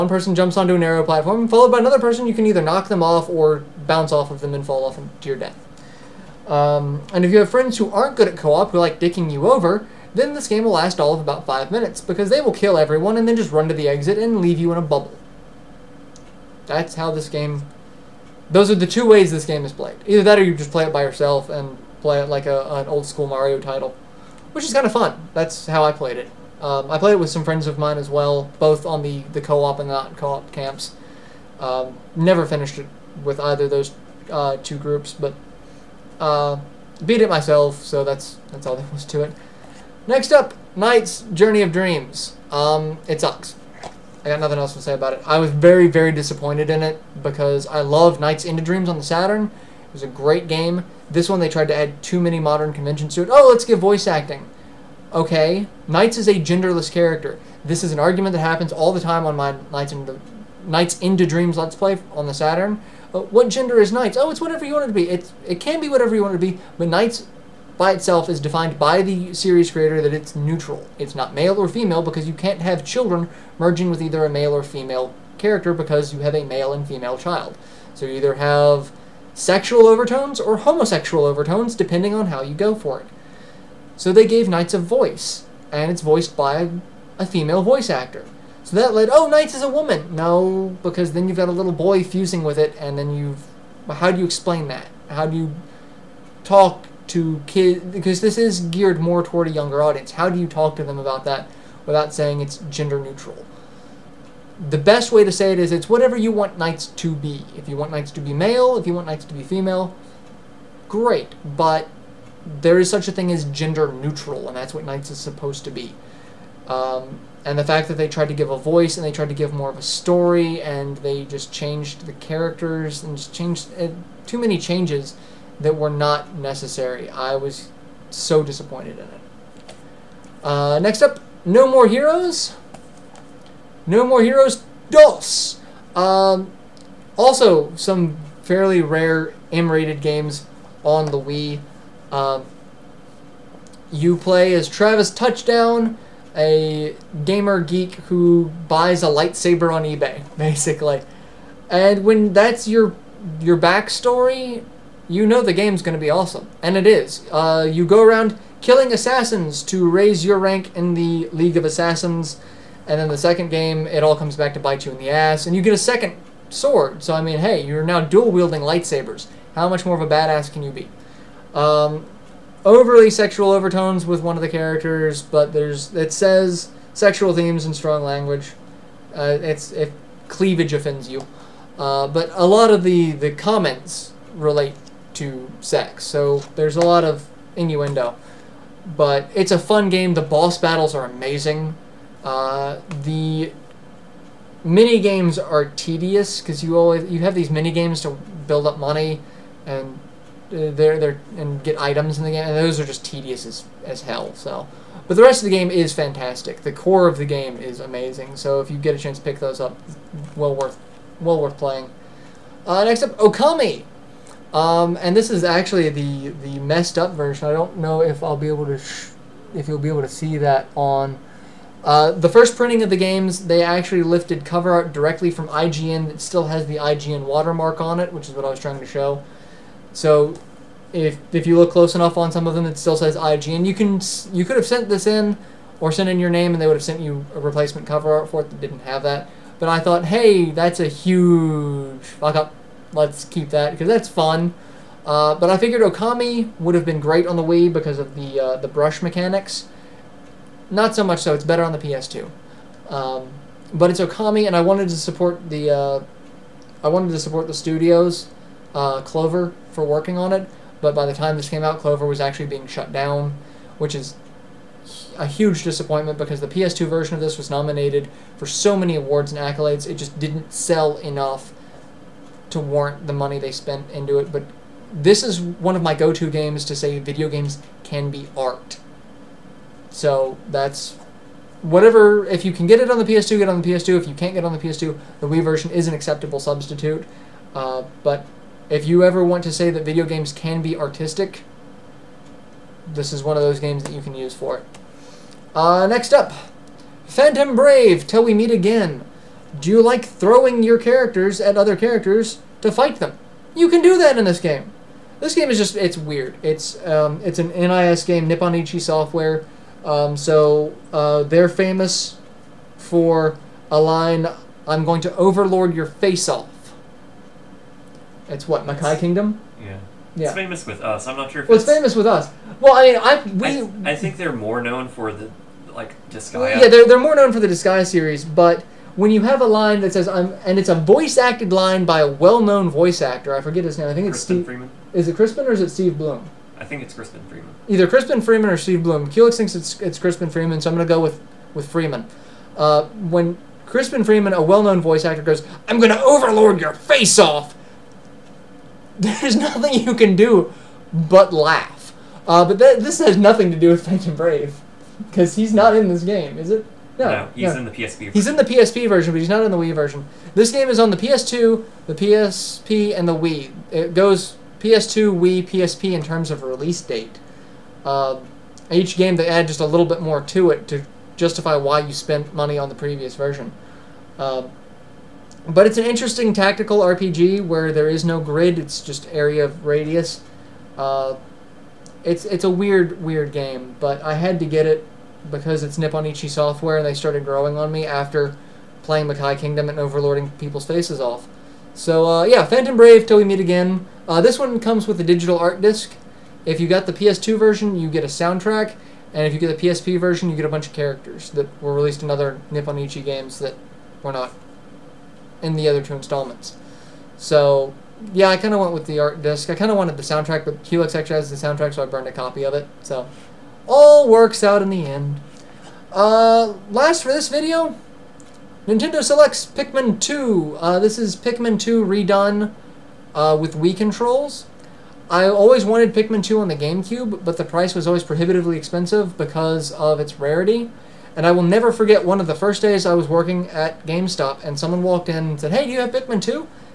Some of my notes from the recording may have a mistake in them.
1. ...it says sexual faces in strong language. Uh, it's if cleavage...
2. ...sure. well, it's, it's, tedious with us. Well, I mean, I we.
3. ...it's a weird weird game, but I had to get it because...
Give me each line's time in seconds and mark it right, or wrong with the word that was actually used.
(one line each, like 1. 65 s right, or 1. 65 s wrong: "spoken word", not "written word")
1. 175 s wrong: "themes", not "faces"
2. 321 s wrong: "famous", not "tedious"
3. 382 s right.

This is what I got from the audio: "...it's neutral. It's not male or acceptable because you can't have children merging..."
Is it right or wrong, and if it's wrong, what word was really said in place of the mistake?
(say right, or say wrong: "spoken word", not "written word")
wrong: "female", not "acceptable".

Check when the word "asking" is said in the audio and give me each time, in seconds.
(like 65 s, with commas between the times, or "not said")
not said.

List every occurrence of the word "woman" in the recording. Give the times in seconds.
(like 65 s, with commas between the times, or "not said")
89 s.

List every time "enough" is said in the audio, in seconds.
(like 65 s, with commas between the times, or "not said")
231 s, 270 s.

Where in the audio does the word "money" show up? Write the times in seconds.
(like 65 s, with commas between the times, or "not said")
198 s, 273 s, 372 s.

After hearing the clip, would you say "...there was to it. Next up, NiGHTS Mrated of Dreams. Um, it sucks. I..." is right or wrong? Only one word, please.
wrong.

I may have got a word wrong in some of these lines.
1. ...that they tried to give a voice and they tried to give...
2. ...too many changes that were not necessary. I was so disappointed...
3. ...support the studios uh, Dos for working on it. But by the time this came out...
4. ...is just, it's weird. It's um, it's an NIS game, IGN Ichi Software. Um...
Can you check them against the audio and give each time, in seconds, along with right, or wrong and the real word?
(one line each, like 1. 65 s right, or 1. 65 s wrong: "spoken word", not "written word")
1. 117 s right
2. 124 s right
3. 257 s wrong: "Clover", not "Dos"
4. 305 s wrong: "Nippon", not "IGN".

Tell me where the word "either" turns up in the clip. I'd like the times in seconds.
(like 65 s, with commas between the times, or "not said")
2 s, 20 s, 33 s, 74 s, 78 s, 337 s.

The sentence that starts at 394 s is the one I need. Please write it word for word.
Uh, this one comes with a digital art disc.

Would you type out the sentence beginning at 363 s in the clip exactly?
It goes PS2, Wii, PSP in terms of release date.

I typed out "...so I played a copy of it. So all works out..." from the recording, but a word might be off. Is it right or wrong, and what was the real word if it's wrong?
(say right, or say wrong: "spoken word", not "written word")
wrong: "burned", not "played".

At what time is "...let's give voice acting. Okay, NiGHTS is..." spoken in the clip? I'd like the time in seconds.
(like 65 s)
53 s.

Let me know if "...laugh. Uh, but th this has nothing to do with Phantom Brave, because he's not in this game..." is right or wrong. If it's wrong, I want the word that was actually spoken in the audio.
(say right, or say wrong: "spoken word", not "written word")
right.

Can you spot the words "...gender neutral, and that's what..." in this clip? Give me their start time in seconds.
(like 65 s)
113 s.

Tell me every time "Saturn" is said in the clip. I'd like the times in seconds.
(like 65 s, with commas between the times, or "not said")
49 s, 62 s.